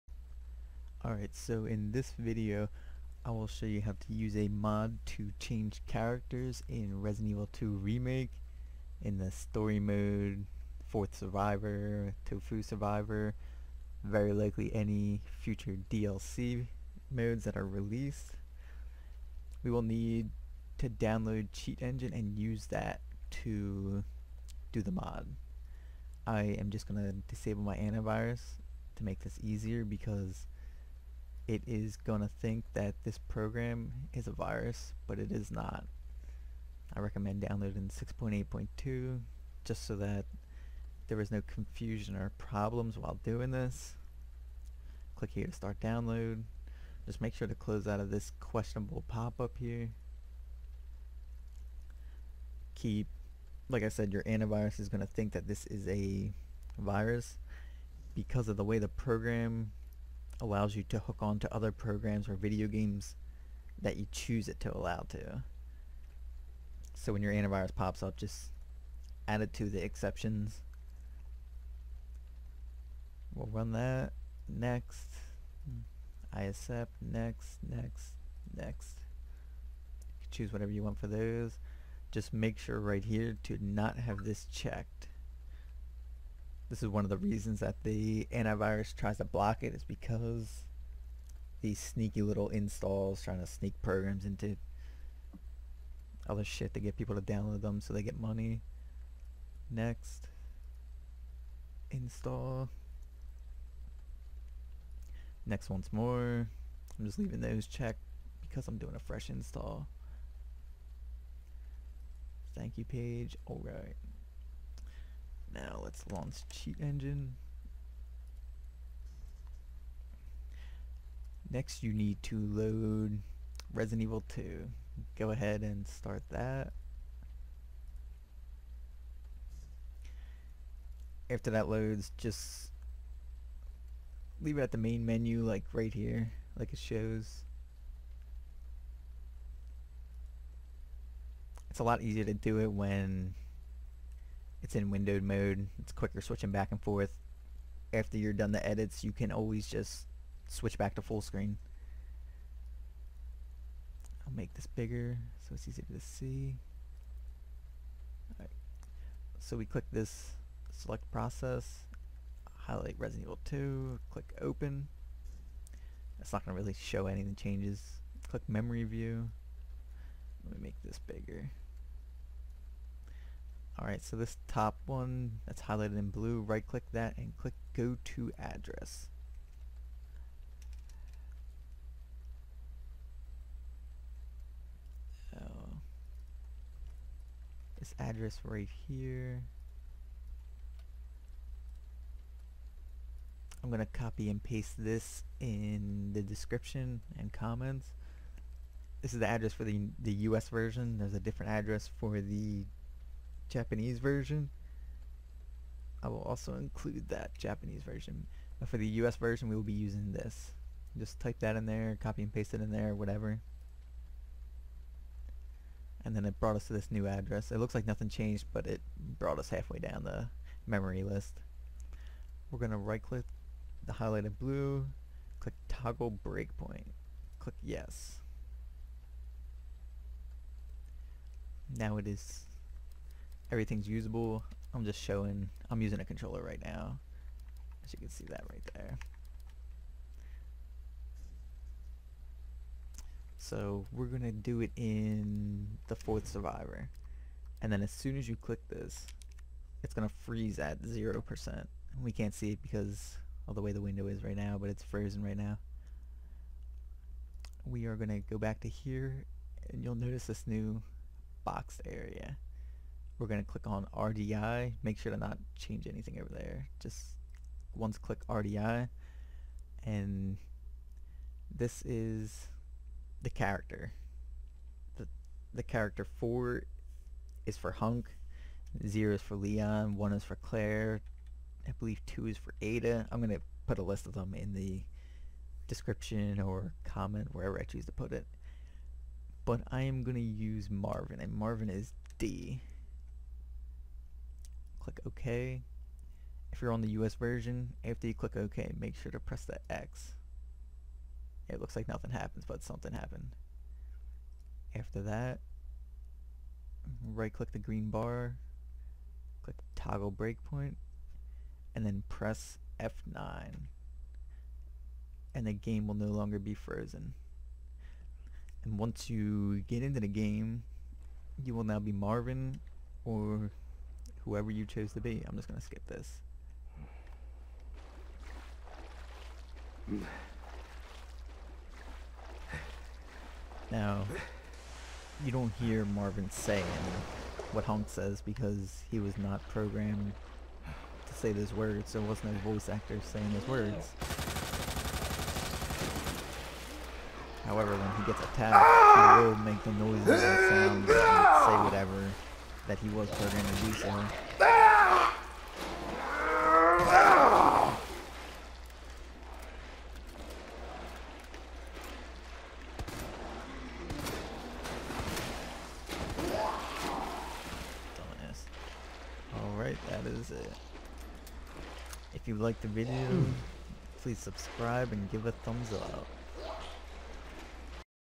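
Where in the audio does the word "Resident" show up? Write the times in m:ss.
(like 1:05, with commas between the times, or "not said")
0:07, 2:03, 2:42.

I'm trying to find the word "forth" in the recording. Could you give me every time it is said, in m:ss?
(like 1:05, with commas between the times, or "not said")
2:26.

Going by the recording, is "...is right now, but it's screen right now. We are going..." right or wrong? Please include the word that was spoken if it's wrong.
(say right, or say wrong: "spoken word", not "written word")
wrong: "frozen", not "screen".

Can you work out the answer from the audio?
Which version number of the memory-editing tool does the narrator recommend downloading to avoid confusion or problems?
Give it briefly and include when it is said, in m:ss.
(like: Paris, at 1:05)
6.8.2, at 0:37.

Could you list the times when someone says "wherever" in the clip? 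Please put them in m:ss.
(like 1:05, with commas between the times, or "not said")
4:47.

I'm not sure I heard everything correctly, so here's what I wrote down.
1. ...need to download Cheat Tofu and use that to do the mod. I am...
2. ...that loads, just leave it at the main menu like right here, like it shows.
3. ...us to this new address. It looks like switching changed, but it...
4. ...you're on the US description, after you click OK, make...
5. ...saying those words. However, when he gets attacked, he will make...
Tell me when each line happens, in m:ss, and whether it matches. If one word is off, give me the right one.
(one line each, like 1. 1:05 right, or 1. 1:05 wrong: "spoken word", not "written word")
1. 0:19 wrong: "Engine", not "Tofu"
2. 2:11 right
3. 3:36 wrong: "nothing", not "switching"
4. 4:56 wrong: "version", not "description"
5. 5:43 right.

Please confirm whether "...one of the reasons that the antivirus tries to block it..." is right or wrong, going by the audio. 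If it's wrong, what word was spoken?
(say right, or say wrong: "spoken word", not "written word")
right.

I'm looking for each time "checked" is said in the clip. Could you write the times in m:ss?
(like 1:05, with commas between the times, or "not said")
1:24, 1:47.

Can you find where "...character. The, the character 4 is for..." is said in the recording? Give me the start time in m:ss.
4:33.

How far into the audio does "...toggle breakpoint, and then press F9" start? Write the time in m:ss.
5:09.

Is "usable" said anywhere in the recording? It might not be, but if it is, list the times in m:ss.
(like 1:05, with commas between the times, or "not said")
3:53.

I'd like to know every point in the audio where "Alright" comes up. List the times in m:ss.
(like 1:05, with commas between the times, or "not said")
0:01, 1:53, 2:38, 2:53, 6:09.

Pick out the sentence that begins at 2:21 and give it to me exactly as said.
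It's a lot easier to do it when it's in windowed mode.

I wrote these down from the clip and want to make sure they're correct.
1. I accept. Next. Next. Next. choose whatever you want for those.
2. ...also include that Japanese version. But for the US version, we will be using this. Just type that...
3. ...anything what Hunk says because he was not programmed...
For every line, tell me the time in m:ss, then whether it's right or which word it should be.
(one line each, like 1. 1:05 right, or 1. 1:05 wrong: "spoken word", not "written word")
1. 1:16 right
2. 3:26 right
3. 5:36 wrong: "saying", not "anything".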